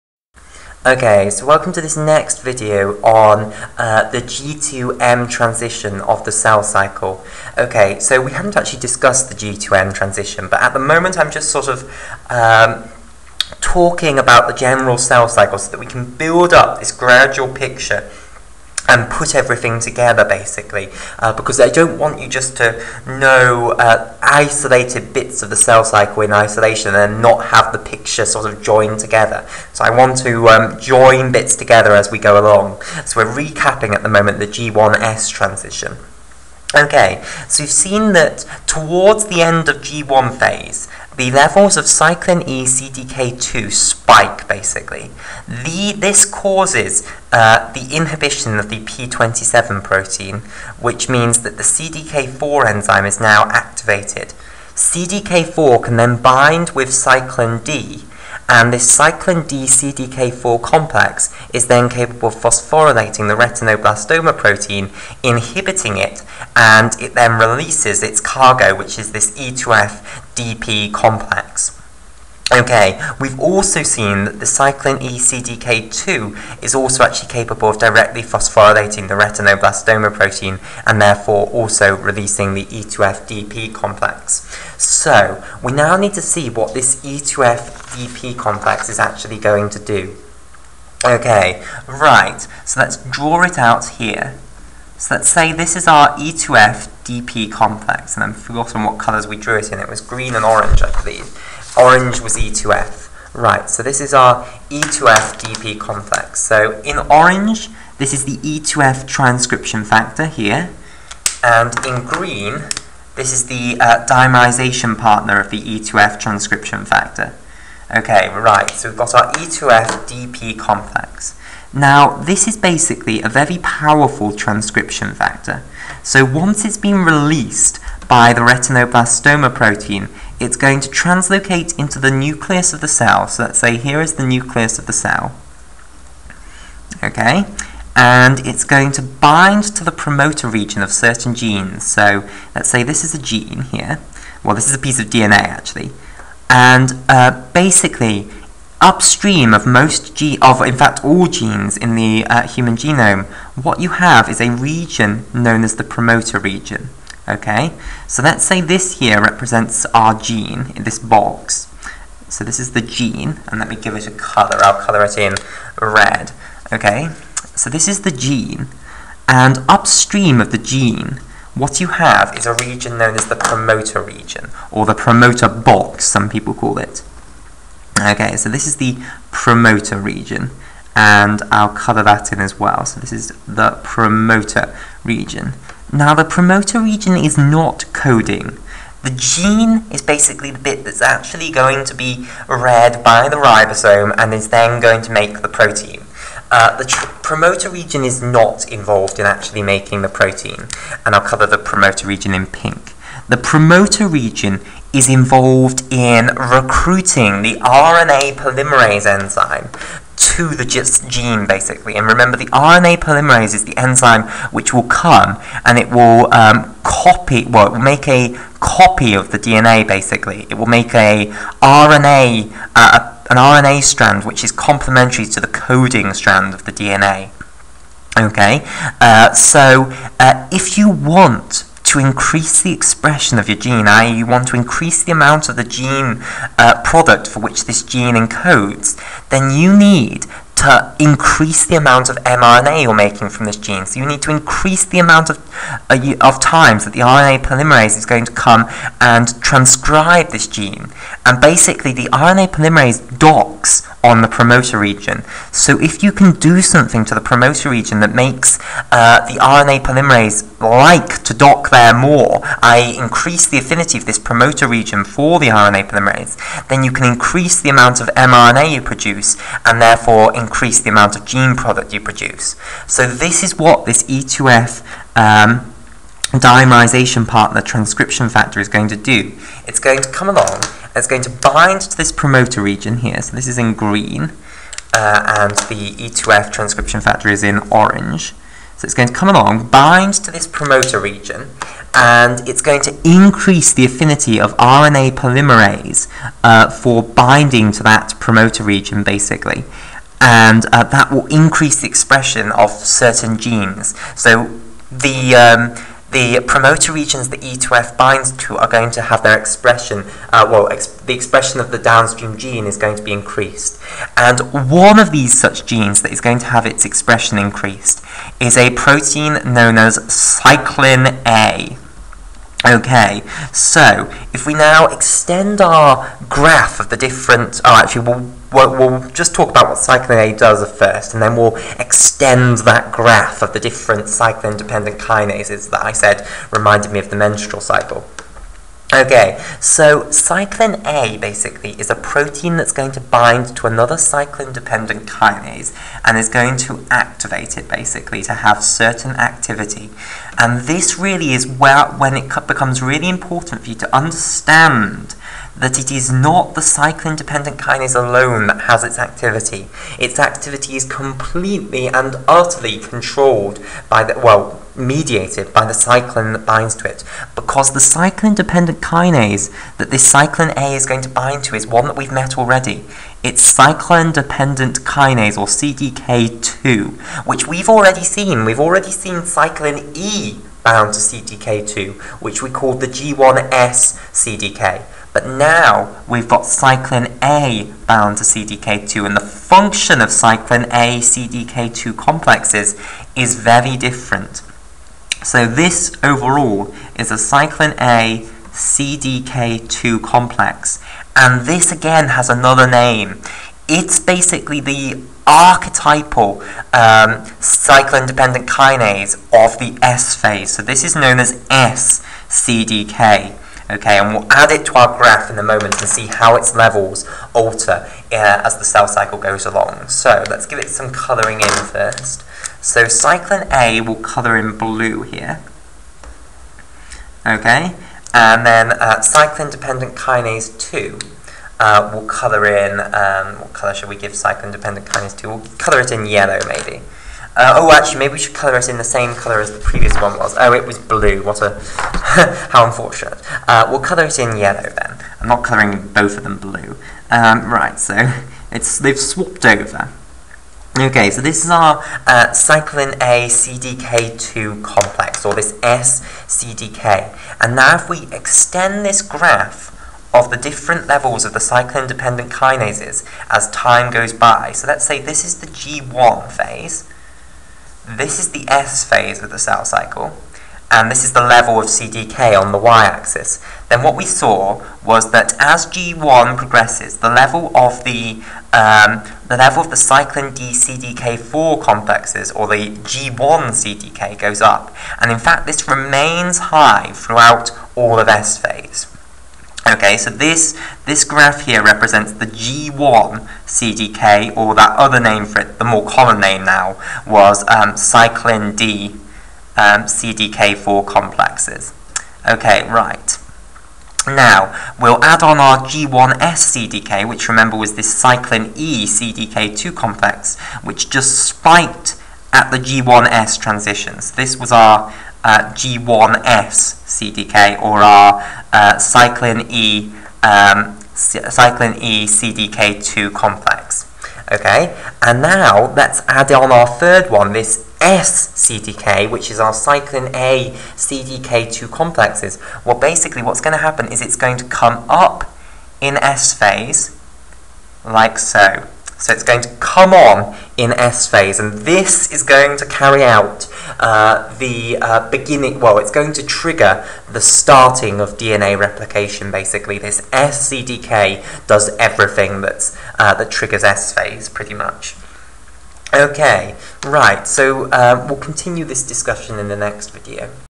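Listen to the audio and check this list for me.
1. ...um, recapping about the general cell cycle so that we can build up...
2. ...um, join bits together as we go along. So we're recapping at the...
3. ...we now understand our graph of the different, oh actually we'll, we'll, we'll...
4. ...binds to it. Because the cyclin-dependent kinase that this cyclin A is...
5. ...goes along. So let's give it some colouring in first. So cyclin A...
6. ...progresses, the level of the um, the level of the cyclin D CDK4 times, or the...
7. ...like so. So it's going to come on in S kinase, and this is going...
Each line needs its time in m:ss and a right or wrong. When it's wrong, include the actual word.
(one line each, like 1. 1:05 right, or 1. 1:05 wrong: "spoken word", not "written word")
1. 0:12 wrong: "talking", not "recapping"
2. 0:30 right
3. 5:24 wrong: "extend", not "understand"
4. 6:06 right
5. 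6:59 right
6. 7:56 wrong: "complexes", not "times"
7. 8:57 wrong: "phase", not "kinase".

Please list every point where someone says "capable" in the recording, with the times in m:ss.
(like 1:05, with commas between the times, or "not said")
1:01, 1:17.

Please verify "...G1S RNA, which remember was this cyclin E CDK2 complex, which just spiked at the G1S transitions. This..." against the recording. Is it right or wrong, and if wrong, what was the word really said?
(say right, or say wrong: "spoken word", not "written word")
wrong: "CDK", not "RNA".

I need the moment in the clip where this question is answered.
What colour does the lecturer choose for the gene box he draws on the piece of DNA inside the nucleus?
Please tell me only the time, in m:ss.
2:44.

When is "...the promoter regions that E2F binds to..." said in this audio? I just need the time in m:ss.
5:06.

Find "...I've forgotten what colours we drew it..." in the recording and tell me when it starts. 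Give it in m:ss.
1:38.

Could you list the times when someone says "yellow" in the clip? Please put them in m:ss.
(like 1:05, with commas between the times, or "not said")
7:16, 7:24.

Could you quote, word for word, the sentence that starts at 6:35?
So this overall is a cyclin A CDK2 complex.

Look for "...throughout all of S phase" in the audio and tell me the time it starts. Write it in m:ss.
8:06.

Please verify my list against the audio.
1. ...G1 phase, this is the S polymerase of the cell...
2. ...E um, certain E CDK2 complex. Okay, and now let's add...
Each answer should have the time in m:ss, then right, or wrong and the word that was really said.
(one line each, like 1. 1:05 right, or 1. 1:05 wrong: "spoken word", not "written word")
1. 7:45 wrong: "phase", not "polymerase"
2. 8:39 wrong: "cyclin", not "certain".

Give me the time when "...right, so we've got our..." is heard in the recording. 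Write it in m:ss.
1:58.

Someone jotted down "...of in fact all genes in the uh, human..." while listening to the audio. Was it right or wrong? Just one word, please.
right.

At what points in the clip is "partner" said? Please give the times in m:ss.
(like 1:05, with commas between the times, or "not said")
1:54, 4:37.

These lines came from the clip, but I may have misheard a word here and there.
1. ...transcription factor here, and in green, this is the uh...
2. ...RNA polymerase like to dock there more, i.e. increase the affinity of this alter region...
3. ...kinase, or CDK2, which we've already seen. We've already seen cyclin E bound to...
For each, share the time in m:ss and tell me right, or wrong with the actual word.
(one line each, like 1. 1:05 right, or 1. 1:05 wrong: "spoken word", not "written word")
1. 1:49 right
2. 4:19 wrong: "promoter", not "alter"
3. 6:14 right.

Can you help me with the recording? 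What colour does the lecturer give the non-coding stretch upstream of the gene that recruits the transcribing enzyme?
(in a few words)
Pink.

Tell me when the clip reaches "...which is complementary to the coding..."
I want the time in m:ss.
3:44.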